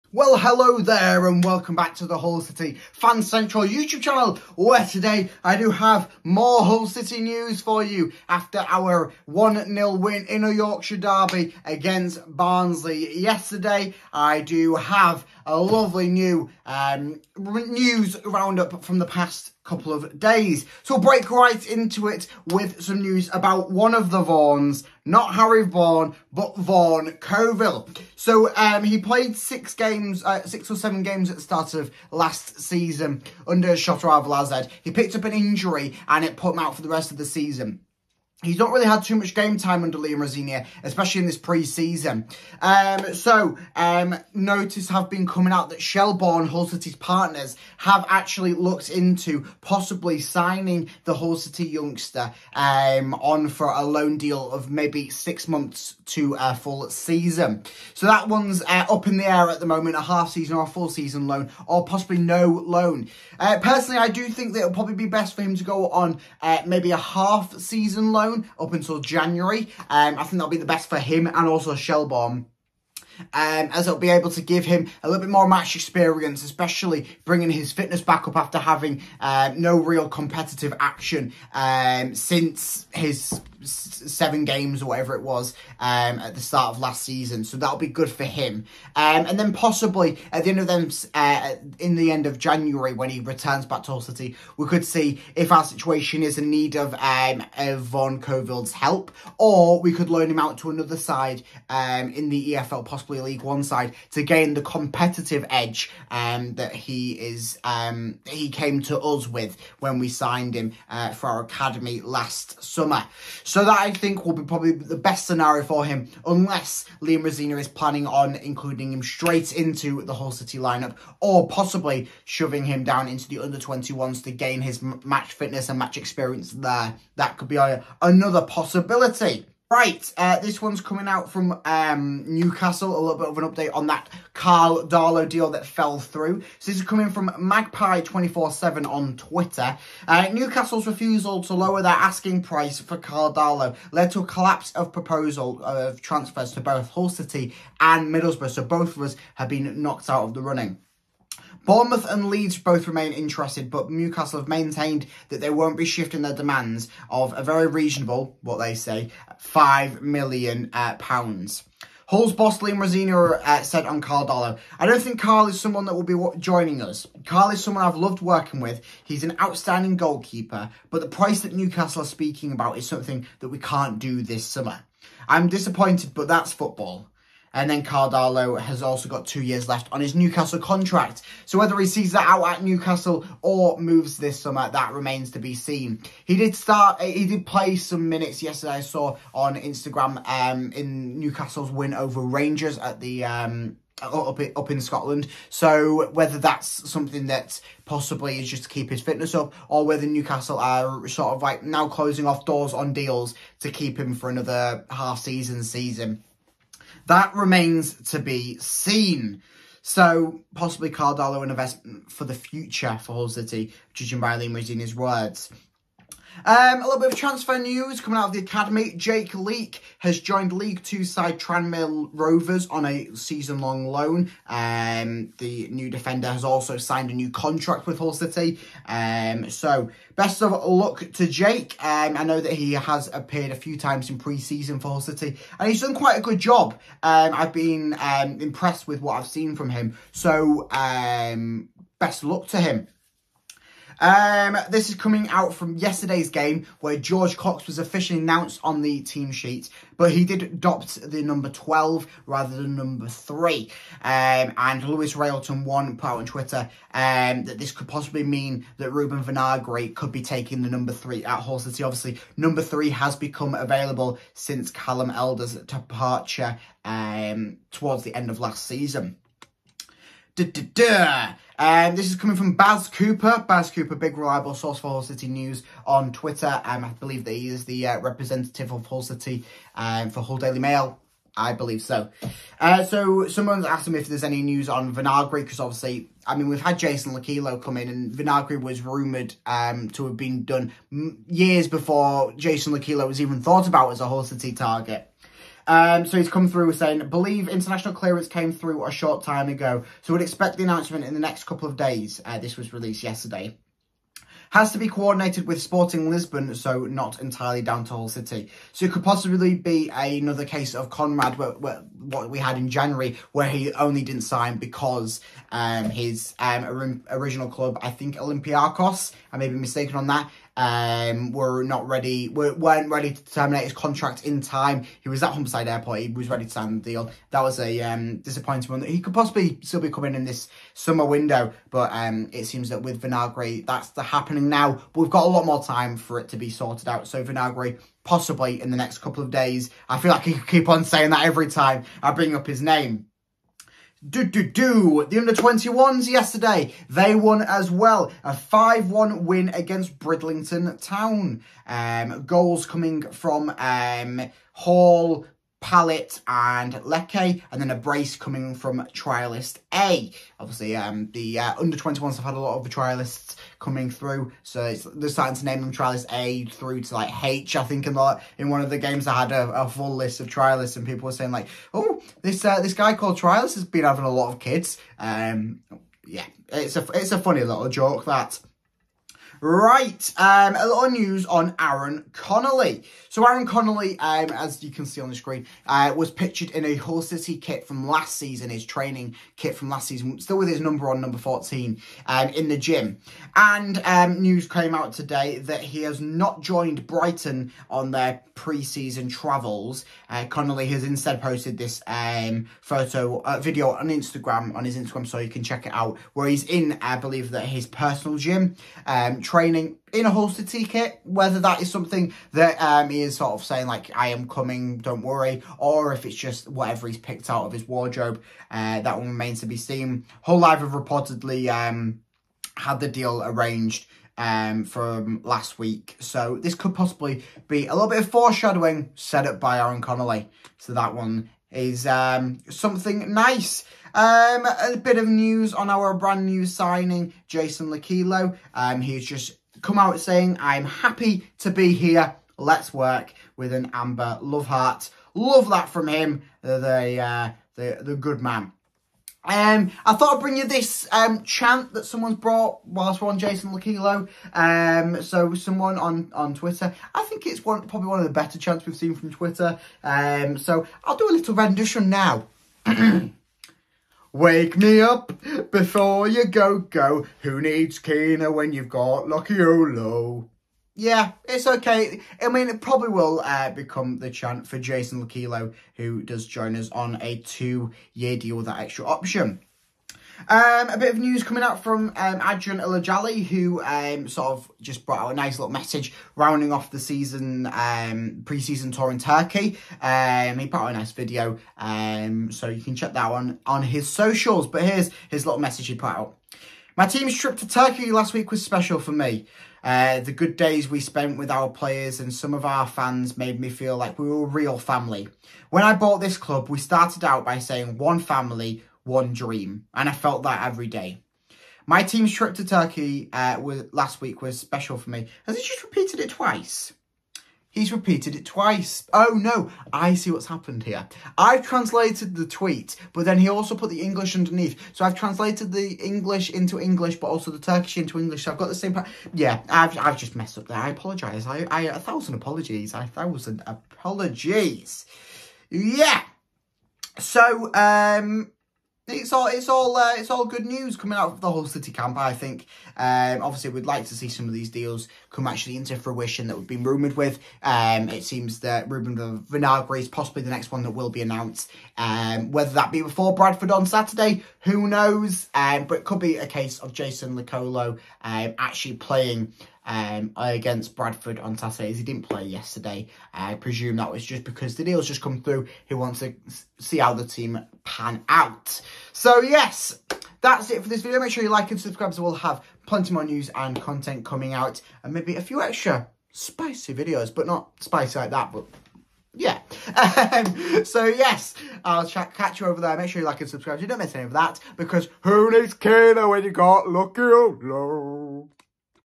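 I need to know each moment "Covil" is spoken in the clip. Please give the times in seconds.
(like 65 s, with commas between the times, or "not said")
27 s, 98 s.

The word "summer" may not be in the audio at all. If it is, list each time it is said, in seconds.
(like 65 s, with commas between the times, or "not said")
112 s, 174 s, 184 s, 330 s.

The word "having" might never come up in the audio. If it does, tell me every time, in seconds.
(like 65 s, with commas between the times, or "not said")
78 s, 373 s.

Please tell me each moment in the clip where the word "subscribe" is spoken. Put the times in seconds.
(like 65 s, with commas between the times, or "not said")
571 s, 583 s.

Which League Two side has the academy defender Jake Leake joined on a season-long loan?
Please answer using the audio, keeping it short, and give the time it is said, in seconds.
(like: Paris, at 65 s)
Tranmere Rovers, at 221 s.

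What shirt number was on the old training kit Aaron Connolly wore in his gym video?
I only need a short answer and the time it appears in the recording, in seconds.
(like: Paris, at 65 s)
14, at 391 s.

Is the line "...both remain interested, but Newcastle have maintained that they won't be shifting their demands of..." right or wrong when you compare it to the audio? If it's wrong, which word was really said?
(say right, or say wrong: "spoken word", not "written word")
right.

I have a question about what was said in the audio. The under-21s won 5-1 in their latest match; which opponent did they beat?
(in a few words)
Bridlington Town.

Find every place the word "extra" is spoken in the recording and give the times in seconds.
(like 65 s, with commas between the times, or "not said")
478 s, 575 s.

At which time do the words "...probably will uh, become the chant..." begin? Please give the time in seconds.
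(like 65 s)
472 s.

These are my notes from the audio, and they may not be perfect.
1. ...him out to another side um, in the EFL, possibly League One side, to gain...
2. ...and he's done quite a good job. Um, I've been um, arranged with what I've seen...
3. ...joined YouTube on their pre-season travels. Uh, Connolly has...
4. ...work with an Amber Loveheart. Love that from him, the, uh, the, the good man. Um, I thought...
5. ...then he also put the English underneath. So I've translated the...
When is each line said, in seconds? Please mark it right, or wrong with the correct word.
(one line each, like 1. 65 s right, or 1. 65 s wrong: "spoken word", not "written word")
1. 100 s right
2. 235 s wrong: "impressed", not "arranged"
3. 396 s wrong: "Brighton", not "YouTube"
4. 442 s right
5. 523 s right.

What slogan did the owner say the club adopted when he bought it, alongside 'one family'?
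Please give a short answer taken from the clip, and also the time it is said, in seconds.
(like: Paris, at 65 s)
one dream, at 508 s.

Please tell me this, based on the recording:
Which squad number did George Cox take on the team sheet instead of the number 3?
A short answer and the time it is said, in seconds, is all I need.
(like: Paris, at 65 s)
12, at 251 s.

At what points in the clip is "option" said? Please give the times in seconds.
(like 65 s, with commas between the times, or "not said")
478 s.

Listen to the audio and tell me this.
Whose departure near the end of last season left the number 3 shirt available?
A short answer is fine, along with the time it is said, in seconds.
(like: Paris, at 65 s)
Callum Elder, at 264 s.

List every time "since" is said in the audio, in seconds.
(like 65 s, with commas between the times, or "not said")
82 s, 264 s.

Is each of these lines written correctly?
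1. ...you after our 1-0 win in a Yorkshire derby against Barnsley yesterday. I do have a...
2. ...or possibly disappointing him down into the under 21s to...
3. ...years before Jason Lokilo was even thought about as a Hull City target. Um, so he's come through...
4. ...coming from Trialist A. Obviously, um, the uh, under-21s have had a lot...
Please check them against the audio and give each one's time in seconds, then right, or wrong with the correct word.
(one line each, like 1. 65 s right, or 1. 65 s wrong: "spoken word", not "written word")
1. 7 s right
2. 121 s wrong: "shoving", not "disappointing"
3. 291 s right
4. 358 s right.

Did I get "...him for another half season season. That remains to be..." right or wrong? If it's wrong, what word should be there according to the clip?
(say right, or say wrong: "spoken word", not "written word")
right.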